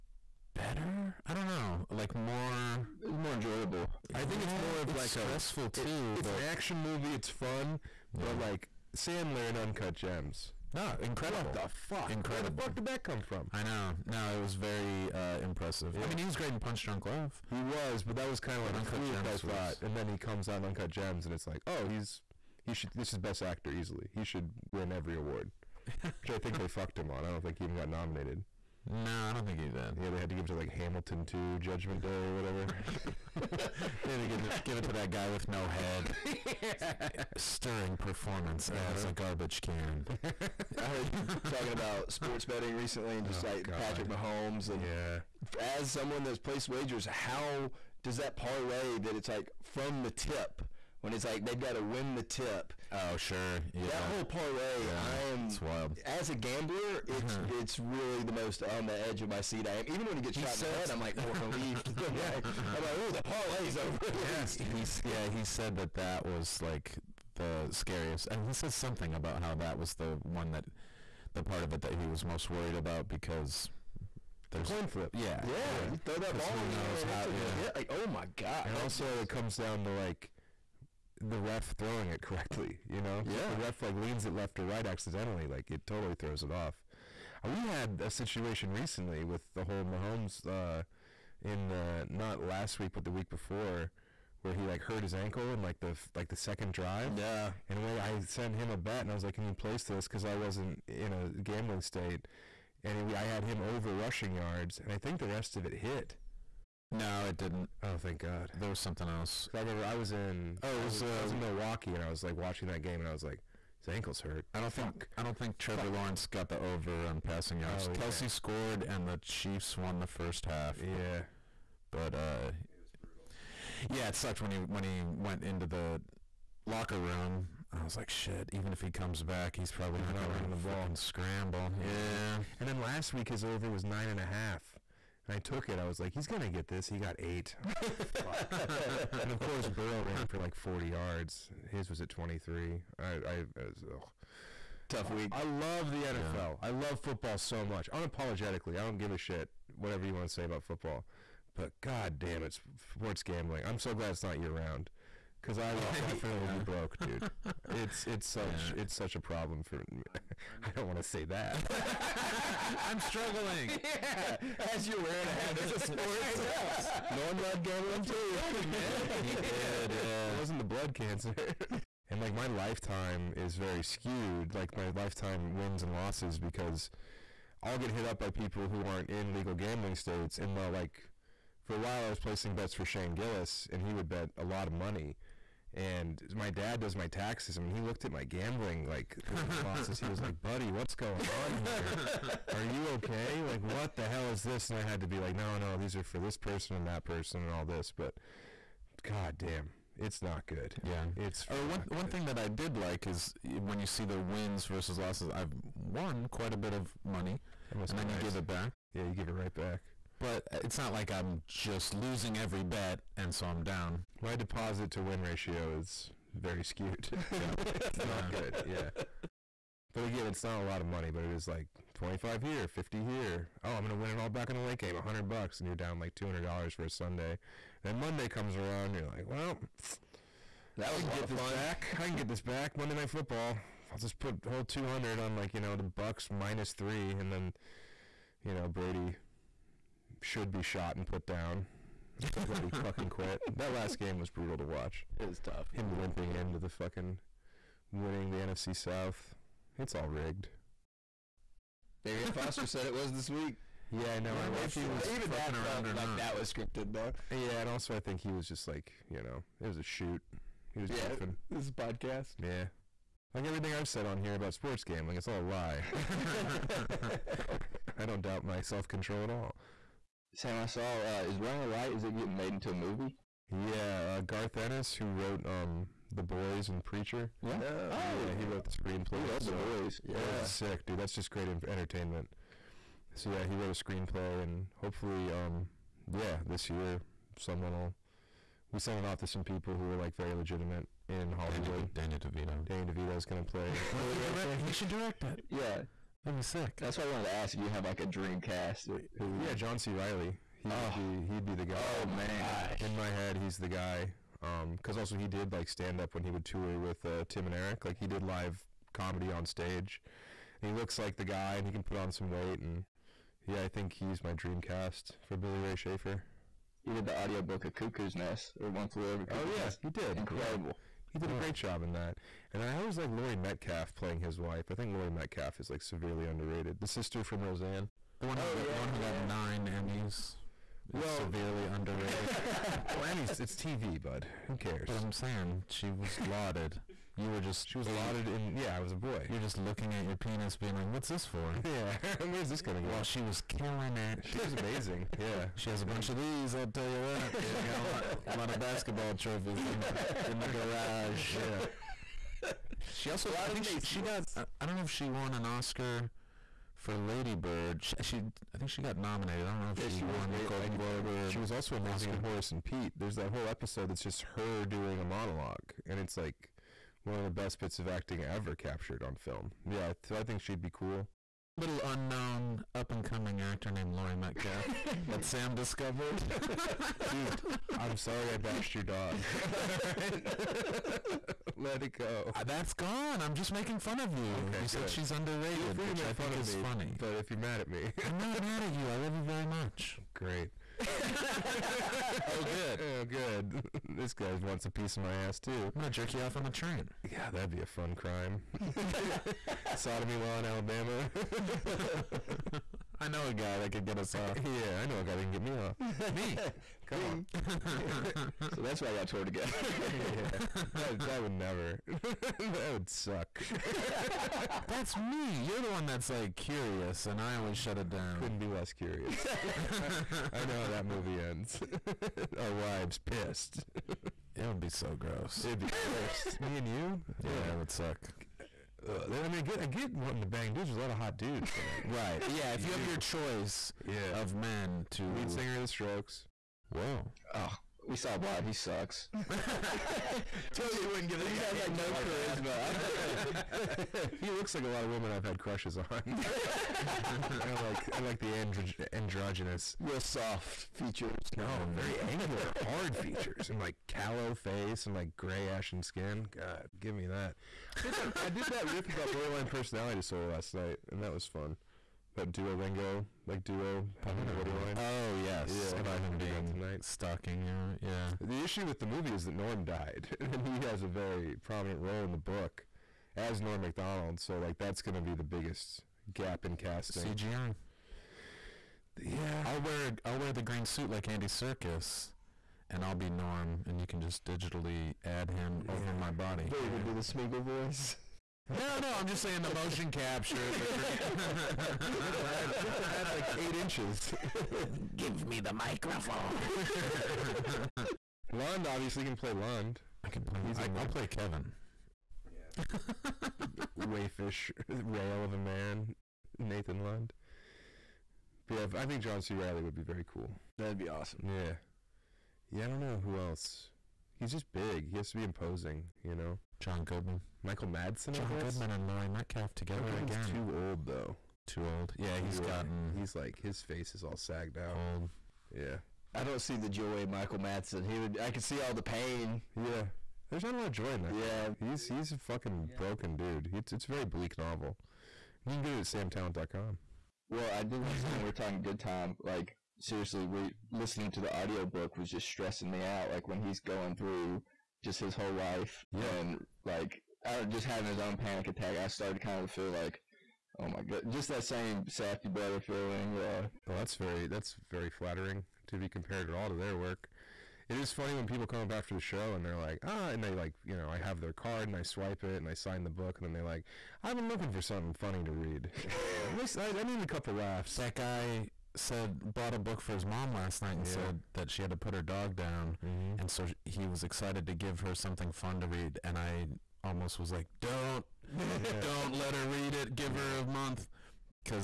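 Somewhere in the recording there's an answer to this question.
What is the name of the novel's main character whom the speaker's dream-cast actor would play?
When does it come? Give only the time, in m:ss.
5:15.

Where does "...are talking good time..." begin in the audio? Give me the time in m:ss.
8:58.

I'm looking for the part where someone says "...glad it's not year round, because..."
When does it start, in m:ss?
2:33.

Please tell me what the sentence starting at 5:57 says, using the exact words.
She, she I think she got nominated.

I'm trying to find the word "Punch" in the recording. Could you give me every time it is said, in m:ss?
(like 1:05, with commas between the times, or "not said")
0:16.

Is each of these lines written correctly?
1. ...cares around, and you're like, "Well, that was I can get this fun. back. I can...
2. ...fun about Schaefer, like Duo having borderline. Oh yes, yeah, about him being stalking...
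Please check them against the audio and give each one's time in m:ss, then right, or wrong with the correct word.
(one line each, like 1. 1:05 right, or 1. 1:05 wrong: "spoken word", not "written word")
1. 3:48 wrong: "comes", not "cares"
2. 7:41 wrong: "Duolingo", not "Schaefer".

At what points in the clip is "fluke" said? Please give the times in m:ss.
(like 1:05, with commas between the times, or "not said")
0:19.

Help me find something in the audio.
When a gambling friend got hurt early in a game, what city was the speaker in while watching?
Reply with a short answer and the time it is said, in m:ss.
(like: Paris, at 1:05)
Milwaukee, at 1:51.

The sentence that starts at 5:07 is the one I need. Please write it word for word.
Like he did live comedy on stage.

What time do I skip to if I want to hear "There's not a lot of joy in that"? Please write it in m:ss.
8:50.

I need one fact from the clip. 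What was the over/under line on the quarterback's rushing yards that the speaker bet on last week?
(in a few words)
9.5.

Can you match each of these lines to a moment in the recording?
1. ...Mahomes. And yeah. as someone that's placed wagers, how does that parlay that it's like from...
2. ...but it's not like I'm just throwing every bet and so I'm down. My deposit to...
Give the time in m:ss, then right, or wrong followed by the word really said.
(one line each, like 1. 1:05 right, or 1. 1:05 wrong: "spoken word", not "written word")
1. 0:44 right
2. 3:30 wrong: "losing", not "throwing".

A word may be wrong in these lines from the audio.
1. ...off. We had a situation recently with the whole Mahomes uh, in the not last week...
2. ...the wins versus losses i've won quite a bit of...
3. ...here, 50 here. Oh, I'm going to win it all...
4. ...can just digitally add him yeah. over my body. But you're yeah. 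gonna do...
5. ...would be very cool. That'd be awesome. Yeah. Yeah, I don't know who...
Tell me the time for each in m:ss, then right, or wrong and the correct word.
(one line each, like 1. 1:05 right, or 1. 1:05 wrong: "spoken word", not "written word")
1. 1:26 right
2. 3:24 right
3. 3:42 right
4. 8:03 right
5. 8:29 right.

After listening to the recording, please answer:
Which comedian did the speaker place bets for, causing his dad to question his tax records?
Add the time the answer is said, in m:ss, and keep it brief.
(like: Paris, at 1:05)
Shane Gillis, at 3:02.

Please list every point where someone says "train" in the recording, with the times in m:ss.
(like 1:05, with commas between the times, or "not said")
6:36.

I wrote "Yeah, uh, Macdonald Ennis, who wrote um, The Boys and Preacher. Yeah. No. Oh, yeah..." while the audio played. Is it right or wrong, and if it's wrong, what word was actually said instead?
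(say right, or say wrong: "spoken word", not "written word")
wrong: "Garth", not "Macdonald".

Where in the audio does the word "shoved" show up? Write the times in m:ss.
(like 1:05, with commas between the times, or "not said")
not said.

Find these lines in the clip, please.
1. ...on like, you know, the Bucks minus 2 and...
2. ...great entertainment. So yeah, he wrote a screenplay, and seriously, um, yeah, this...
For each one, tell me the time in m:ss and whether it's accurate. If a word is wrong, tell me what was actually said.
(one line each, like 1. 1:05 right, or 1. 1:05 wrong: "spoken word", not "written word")
1. 3:55 wrong: "3", not "2"
2. 4:41 wrong: "hopefully", not "seriously".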